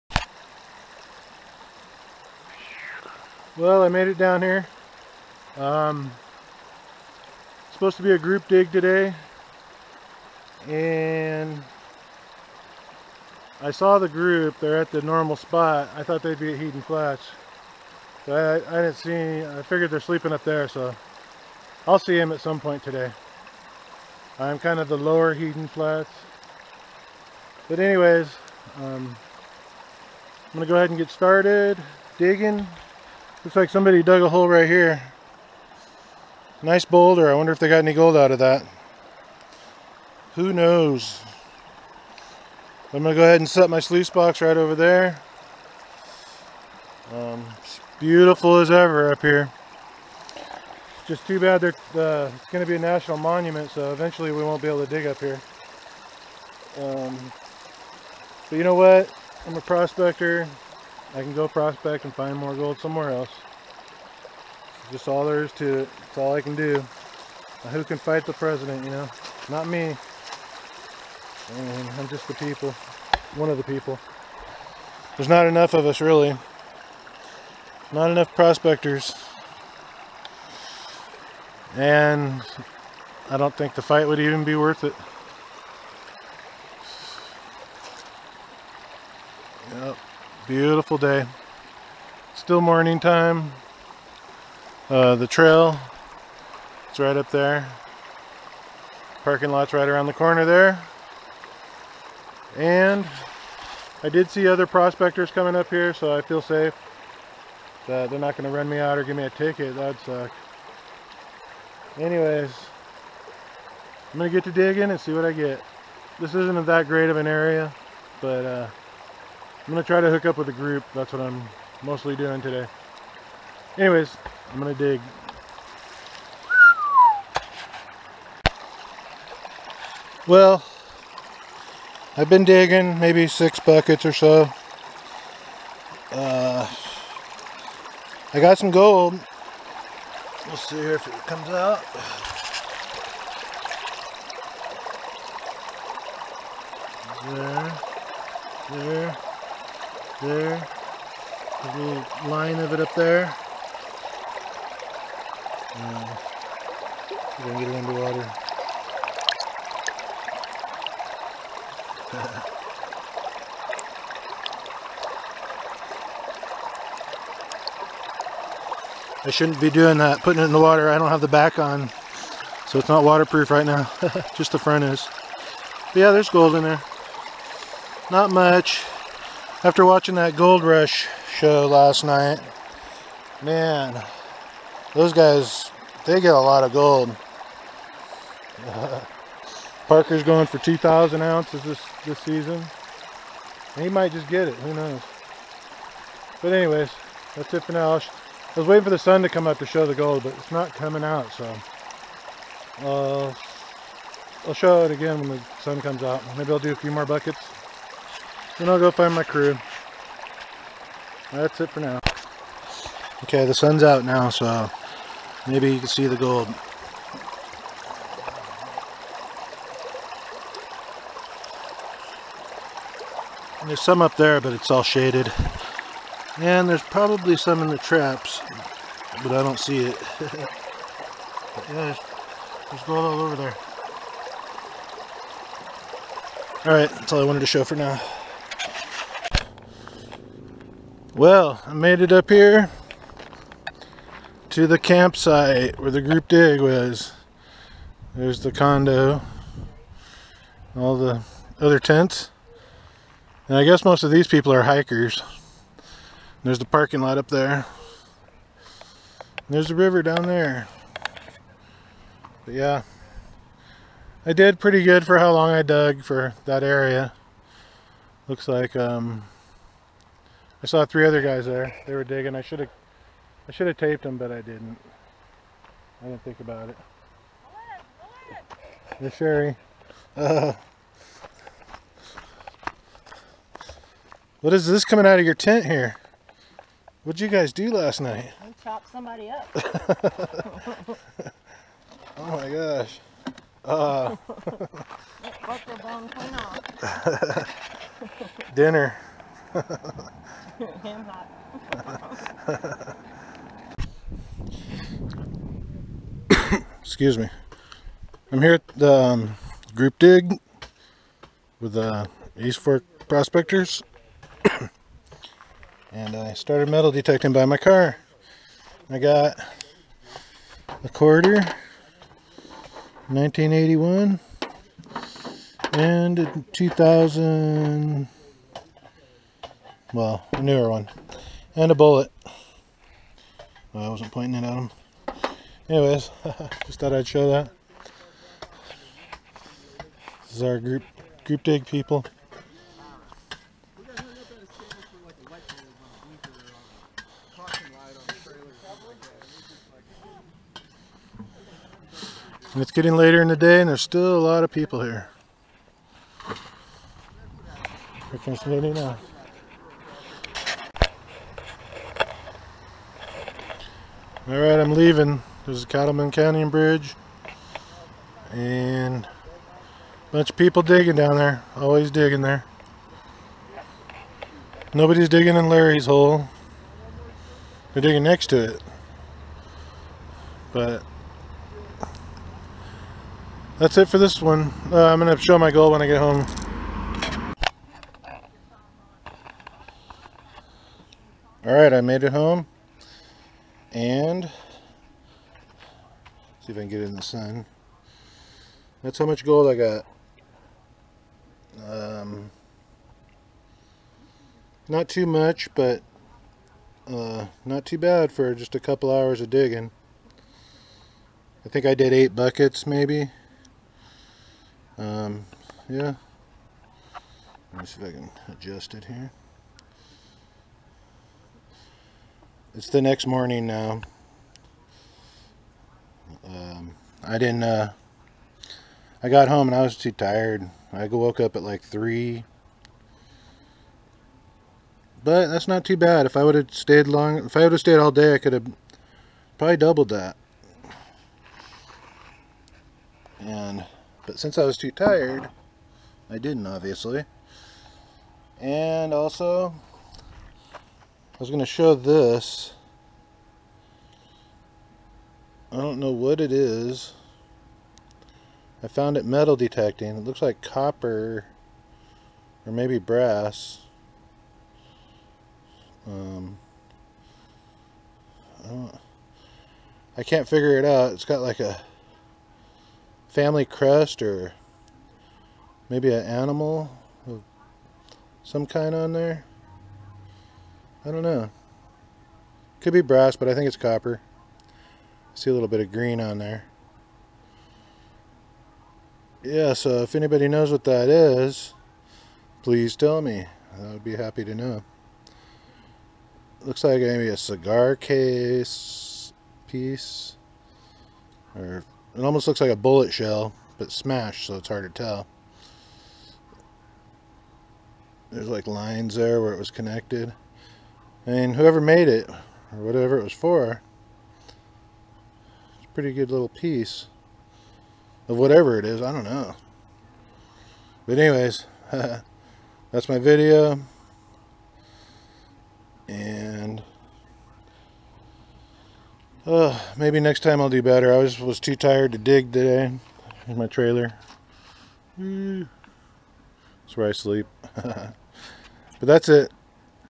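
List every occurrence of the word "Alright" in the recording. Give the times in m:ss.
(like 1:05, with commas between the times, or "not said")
3:56, 6:31.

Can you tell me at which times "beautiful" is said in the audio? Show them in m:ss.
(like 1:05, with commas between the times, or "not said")
0:47, 1:30.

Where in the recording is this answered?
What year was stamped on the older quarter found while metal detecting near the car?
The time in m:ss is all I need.
5:23.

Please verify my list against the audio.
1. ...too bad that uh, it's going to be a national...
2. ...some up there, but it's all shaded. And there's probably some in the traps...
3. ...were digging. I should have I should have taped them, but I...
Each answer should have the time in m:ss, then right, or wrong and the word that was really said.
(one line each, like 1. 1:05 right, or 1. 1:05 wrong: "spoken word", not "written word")
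1. 0:51 right
2. 3:43 right
3. 4:31 right.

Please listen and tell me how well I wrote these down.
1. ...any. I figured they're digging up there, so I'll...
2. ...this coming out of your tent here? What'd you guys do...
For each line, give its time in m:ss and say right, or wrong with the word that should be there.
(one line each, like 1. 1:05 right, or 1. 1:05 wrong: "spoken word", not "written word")
1. 0:19 wrong: "sleeping", not "digging"
2. 4:44 right.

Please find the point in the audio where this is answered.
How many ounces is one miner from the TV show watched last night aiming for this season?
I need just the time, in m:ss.
3:10.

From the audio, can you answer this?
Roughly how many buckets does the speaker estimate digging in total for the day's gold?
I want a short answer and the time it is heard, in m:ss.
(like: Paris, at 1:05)
8, at 6:51.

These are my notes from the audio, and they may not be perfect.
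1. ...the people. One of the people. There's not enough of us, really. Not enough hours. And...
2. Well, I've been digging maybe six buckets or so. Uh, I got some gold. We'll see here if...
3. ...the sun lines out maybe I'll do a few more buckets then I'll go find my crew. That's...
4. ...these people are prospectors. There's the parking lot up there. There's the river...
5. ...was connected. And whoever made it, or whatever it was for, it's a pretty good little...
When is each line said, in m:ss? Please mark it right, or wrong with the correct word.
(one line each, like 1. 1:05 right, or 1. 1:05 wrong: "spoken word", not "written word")
1. 1:12 wrong: "prospectors", not "hours"
2. 2:10 right
3. 3:25 wrong: "comes", not "lines"
4. 4:14 wrong: "hikers", not "prospectors"
5. 8:29 right.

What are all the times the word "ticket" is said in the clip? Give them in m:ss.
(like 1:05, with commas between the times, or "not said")
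1:49.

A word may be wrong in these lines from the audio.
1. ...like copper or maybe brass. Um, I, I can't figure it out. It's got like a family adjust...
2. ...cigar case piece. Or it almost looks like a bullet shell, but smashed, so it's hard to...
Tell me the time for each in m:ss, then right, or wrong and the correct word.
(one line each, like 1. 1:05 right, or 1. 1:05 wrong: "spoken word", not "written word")
1. 7:40 wrong: "crest", not "adjust"
2. 8:17 right.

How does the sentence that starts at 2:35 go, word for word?
And we're going to get it underwater.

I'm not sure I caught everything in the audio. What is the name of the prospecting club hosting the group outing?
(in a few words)
East Fork prospectors.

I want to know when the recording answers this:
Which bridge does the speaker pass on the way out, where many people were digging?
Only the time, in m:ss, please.
6:05.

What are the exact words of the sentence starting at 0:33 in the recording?
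Looks like somebody dug a hole right here.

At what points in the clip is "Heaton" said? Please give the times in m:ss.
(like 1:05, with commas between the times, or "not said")
0:16, 0:25.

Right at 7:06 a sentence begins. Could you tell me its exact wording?
Um, I didn't, uh, I got home and I was too tired.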